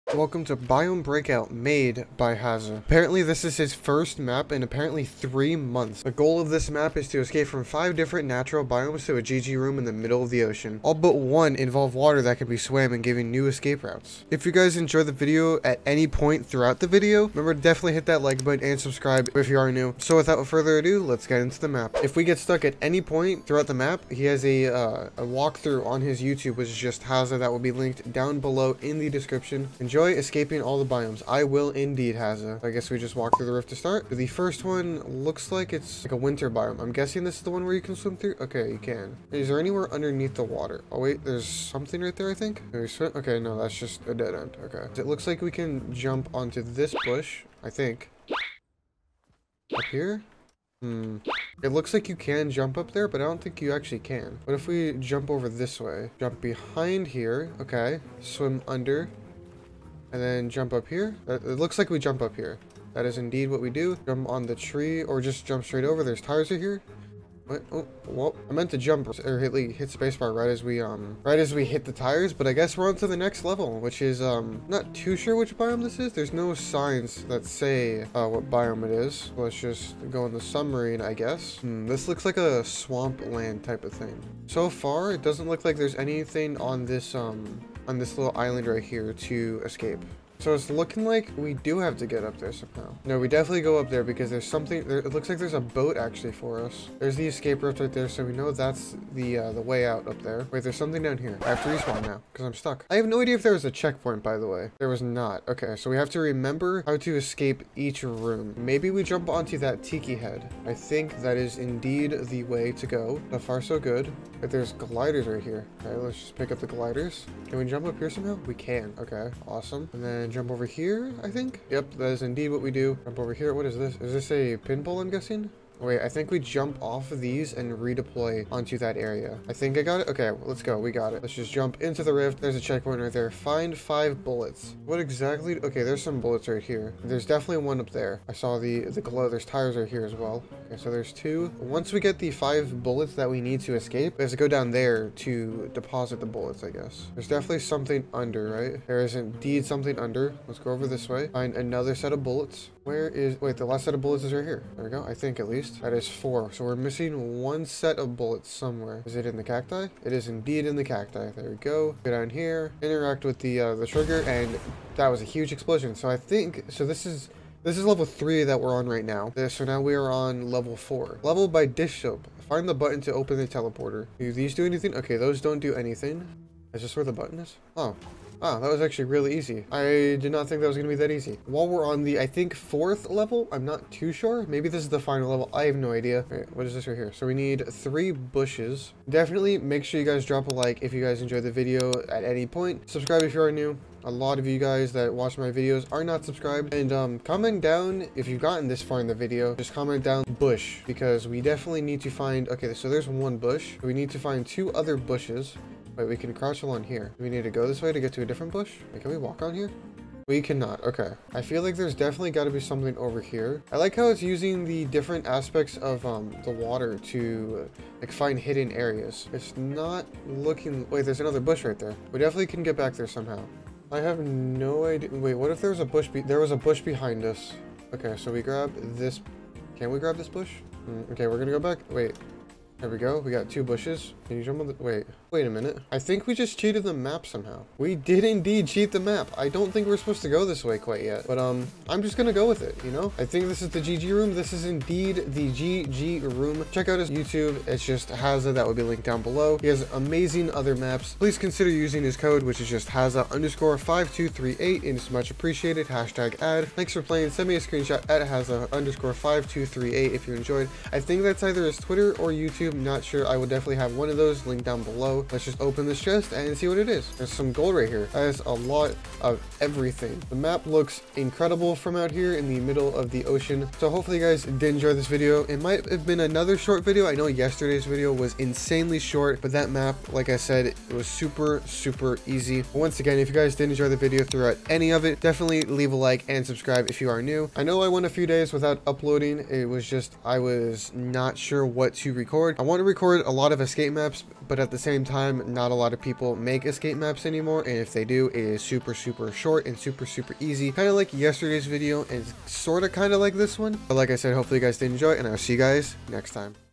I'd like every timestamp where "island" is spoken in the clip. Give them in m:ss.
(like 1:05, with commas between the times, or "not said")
1:28.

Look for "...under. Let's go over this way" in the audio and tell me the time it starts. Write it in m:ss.
2:29.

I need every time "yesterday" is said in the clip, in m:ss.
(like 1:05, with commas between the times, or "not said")
4:37, 5:01.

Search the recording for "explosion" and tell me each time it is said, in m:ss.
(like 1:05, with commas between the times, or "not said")
2:45.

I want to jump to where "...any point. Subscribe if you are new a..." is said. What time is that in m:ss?
3:12.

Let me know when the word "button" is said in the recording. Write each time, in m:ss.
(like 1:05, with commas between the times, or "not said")
0:18, 2:52, 2:57.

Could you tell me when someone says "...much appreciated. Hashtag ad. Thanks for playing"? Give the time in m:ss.
4:15.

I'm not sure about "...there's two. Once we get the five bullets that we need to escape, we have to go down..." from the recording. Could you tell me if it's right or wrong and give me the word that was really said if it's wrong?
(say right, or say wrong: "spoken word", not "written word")
right.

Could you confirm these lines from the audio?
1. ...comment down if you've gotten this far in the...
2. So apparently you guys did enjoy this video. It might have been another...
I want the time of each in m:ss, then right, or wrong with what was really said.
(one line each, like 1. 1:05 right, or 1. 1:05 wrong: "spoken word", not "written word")
1. 3:17 right
2. 4:33 wrong: "hopefully", not "apparently".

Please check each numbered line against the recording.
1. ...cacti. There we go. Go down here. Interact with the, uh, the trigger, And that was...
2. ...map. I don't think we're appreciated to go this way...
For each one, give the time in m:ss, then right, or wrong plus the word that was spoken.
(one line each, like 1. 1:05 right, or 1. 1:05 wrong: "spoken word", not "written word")
1. 2:40 right
2. 3:58 wrong: "supposed", not "appreciated".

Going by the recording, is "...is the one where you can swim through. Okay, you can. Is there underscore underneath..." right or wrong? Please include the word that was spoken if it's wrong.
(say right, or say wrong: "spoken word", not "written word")
wrong: "anywhere", not "underscore".